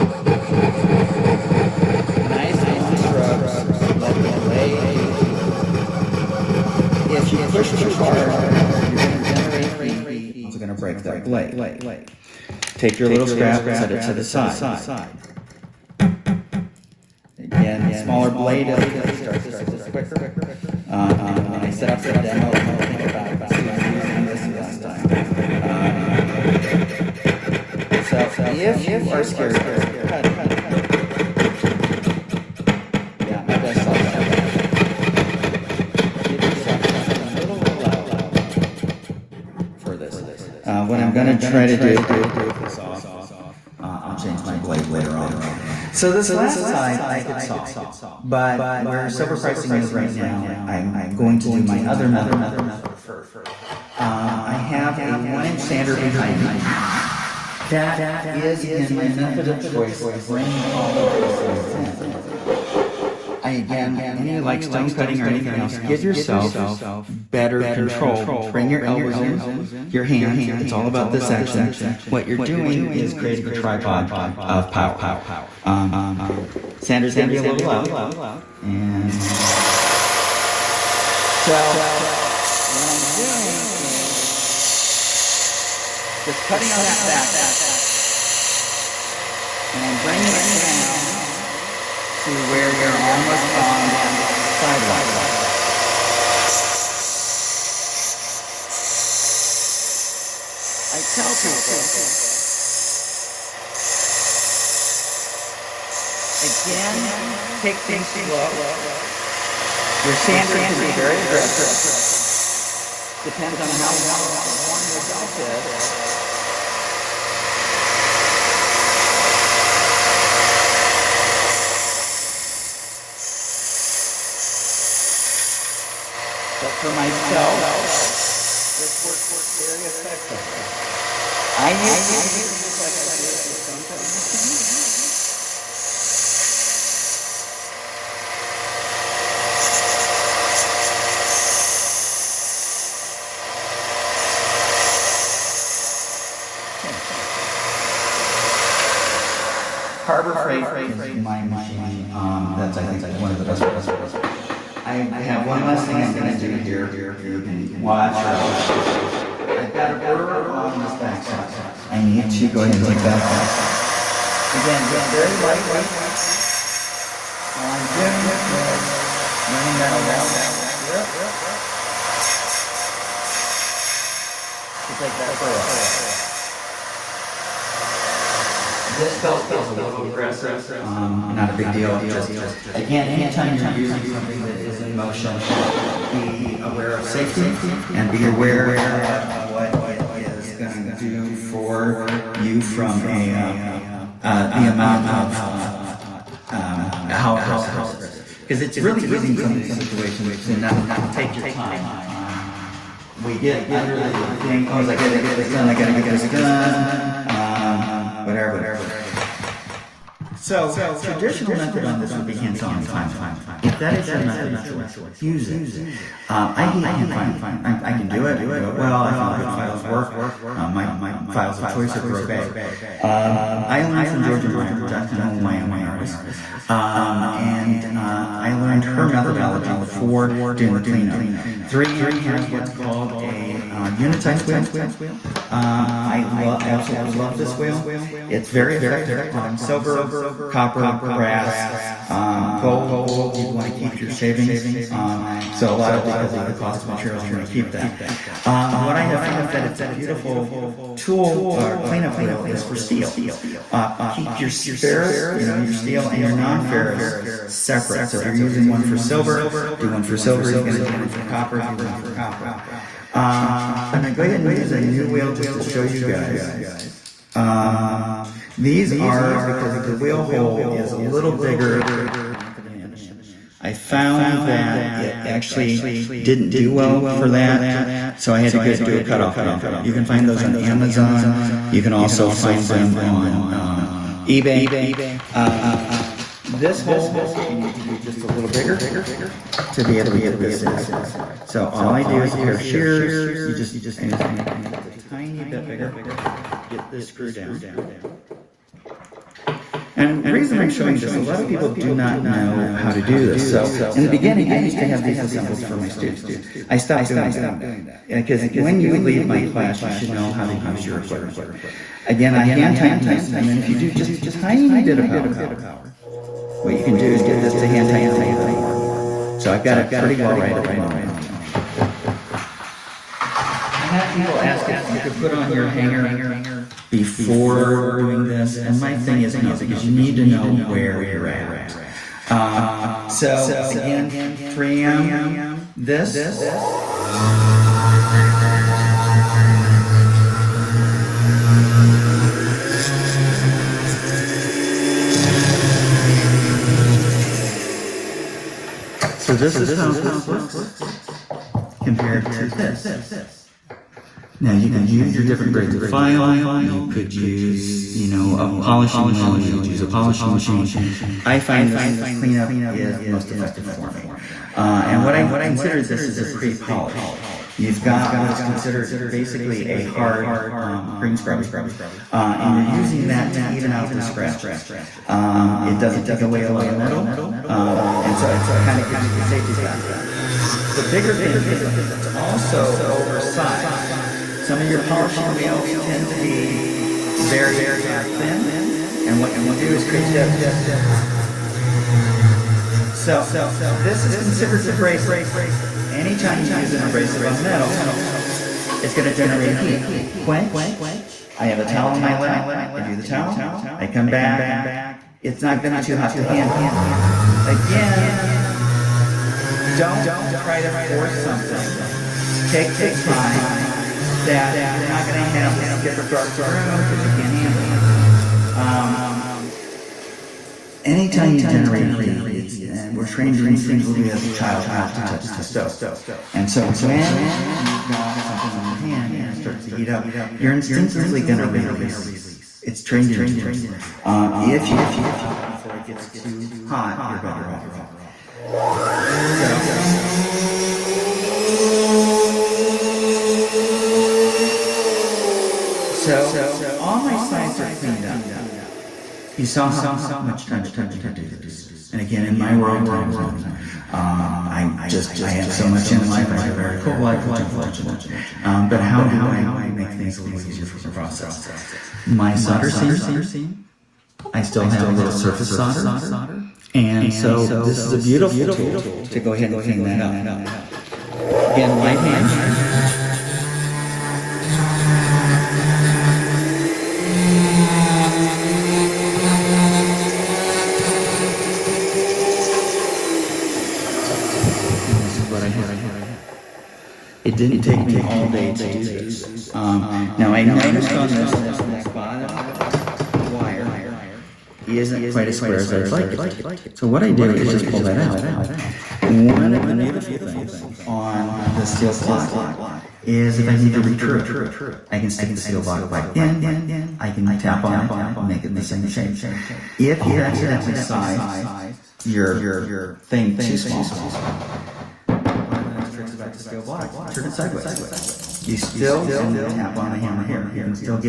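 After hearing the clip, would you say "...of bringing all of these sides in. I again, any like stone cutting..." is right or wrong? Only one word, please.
right.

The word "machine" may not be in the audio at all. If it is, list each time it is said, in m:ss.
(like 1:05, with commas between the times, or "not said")
2:14, 2:31, 6:00.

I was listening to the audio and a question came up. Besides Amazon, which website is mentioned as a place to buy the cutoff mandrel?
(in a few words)
eBay.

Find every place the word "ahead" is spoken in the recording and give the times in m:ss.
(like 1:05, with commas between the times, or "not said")
2:42, 4:24, 7:49.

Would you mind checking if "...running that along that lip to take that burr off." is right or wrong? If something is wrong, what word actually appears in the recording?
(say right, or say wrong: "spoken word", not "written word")
right.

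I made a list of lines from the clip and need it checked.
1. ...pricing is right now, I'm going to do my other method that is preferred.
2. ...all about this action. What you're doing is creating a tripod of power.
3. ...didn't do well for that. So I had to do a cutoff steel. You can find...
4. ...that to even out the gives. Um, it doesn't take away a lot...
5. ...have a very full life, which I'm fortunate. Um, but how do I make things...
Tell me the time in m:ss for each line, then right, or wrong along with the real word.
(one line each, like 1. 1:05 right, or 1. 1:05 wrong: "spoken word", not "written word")
1. 0:49 right
2. 1:10 right
3. 4:36 wrong: "mandrel", not "steel"
4. 6:13 wrong: "scratches", not "gives"
5. 7:36 right.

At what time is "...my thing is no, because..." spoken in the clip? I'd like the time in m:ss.
5:28.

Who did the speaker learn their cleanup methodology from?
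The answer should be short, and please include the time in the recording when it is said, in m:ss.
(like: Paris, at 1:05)
Georgia Meyer, at 3:44.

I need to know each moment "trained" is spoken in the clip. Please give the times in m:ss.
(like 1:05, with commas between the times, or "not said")
7:03, 7:12.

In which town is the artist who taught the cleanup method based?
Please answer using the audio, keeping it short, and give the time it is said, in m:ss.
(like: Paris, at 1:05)
Jackson Hole, at 3:44.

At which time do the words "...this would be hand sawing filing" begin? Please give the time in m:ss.
3:31.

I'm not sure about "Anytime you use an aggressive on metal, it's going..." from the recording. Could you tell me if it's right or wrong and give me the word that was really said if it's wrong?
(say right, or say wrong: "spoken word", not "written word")
wrong: "abrasive", not "aggressive".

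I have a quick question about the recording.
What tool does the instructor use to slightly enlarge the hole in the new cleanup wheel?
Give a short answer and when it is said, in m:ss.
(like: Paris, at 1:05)
shears, at 4:52.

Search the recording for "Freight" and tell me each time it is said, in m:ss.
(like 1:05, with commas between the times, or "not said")
2:30.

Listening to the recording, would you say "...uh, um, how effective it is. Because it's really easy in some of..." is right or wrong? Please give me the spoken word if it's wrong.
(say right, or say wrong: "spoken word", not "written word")
wrong: "aggressive", not "effective".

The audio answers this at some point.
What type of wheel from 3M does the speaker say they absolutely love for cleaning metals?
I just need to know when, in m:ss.
3:53.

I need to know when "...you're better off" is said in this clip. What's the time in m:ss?
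7:17.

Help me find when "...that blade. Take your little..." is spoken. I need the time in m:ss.
0:11.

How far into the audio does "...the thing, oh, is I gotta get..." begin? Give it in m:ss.
3:23.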